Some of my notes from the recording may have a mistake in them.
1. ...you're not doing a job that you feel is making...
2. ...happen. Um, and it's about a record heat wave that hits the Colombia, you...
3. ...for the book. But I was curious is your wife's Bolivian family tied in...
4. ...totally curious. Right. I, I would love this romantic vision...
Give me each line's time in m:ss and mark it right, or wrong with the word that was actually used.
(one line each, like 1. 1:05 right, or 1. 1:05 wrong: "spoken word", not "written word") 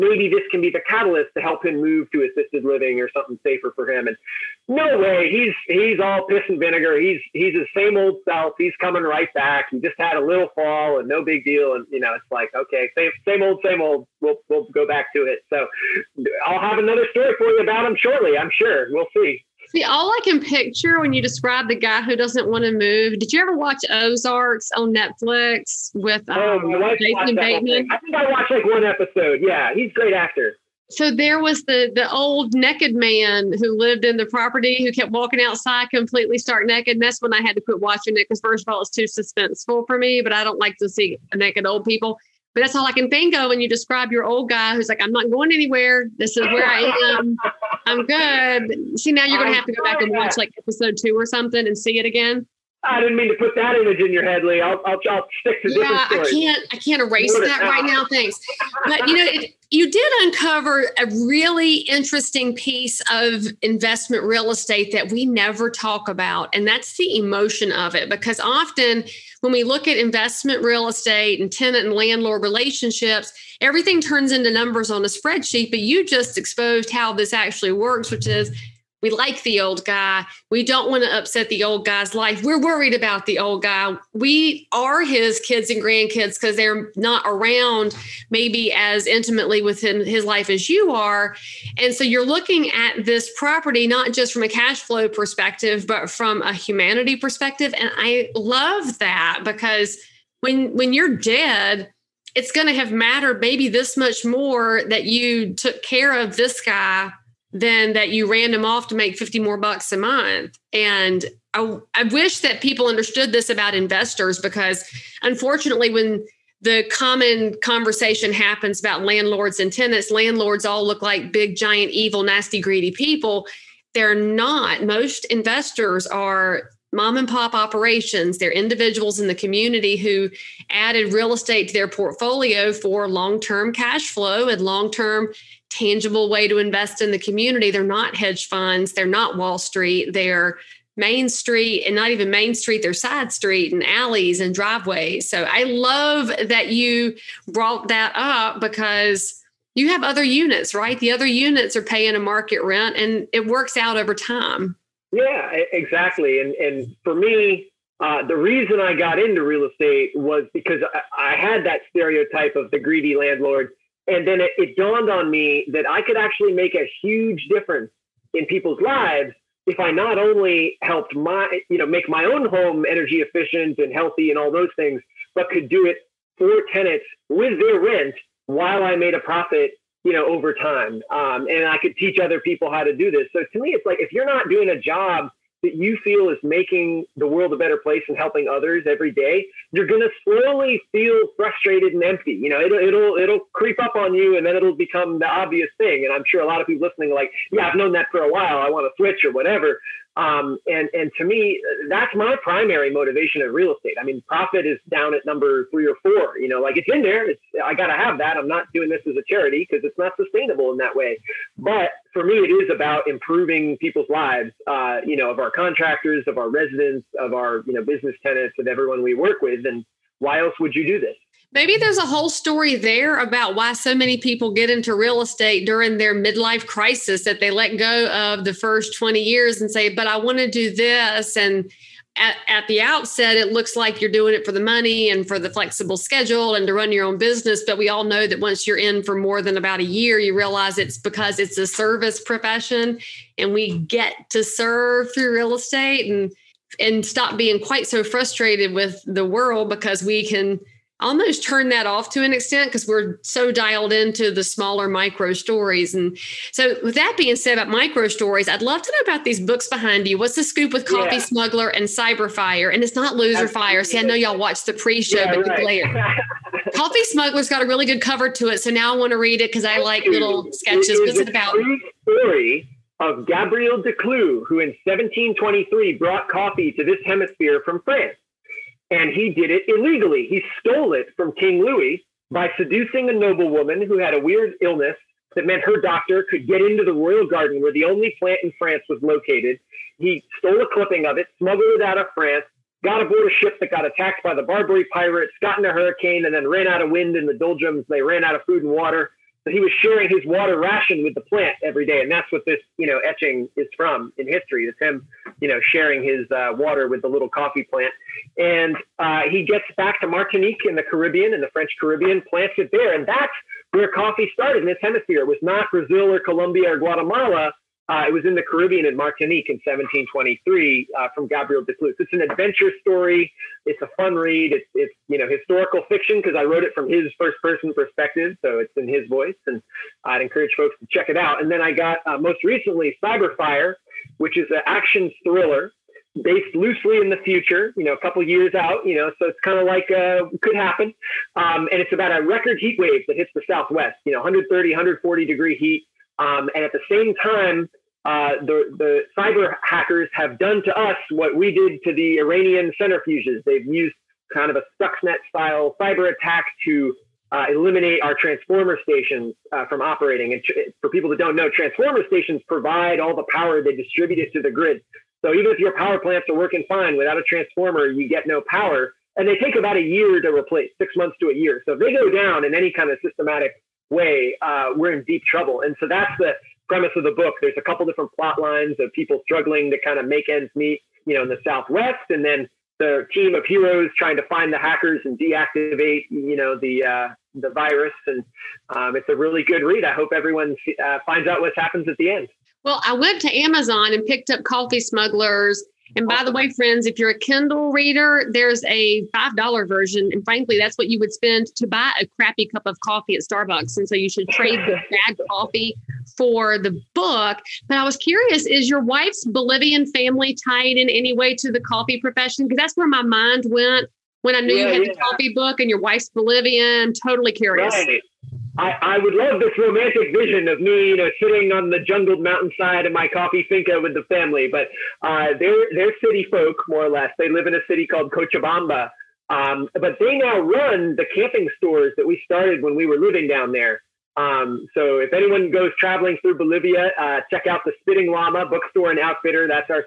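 1. 3:04 right
2. 5:40 wrong: "Southwest", not "Colombia"
3. 6:46 right
4. 6:57 right.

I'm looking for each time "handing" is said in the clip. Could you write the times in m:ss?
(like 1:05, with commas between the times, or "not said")
not said.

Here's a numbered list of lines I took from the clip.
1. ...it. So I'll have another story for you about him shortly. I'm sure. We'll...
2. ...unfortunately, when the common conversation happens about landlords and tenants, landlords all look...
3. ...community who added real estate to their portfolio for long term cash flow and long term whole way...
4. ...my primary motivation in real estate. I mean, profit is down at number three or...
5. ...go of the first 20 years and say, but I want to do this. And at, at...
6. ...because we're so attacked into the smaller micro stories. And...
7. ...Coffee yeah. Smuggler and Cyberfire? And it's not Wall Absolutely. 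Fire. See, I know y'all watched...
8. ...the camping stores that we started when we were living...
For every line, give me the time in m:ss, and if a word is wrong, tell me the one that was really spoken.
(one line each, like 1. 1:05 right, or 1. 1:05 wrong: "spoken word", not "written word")
1. 0:15 right
2. 1:55 right
3. 2:09 wrong: "tangible", not "whole"
4. 3:22 right
5. 3:47 right
6. 4:12 wrong: "dialed", not "attacked"
7. 4:20 wrong: "Loser", not "Wall"
8. 7:10 right.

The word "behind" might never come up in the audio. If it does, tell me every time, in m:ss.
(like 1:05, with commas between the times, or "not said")
4:19.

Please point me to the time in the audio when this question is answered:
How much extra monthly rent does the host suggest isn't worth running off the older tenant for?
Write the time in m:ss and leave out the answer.
1:49.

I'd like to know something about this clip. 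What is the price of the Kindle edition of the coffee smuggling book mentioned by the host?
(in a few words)
$5.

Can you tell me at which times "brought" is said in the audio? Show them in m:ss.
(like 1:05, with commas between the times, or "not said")
2:27, 4:35.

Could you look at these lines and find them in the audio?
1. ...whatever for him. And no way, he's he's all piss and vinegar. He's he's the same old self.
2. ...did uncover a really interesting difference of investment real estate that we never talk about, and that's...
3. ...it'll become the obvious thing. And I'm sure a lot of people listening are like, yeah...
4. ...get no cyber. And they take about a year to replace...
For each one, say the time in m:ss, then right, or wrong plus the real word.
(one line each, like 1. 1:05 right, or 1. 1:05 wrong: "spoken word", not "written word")
1. 0:03 wrong: "safer", not "whatever"
2. 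0:59 wrong: "piece", not "difference"
3. 3:14 right
4. 6:08 wrong: "power", not "cyber".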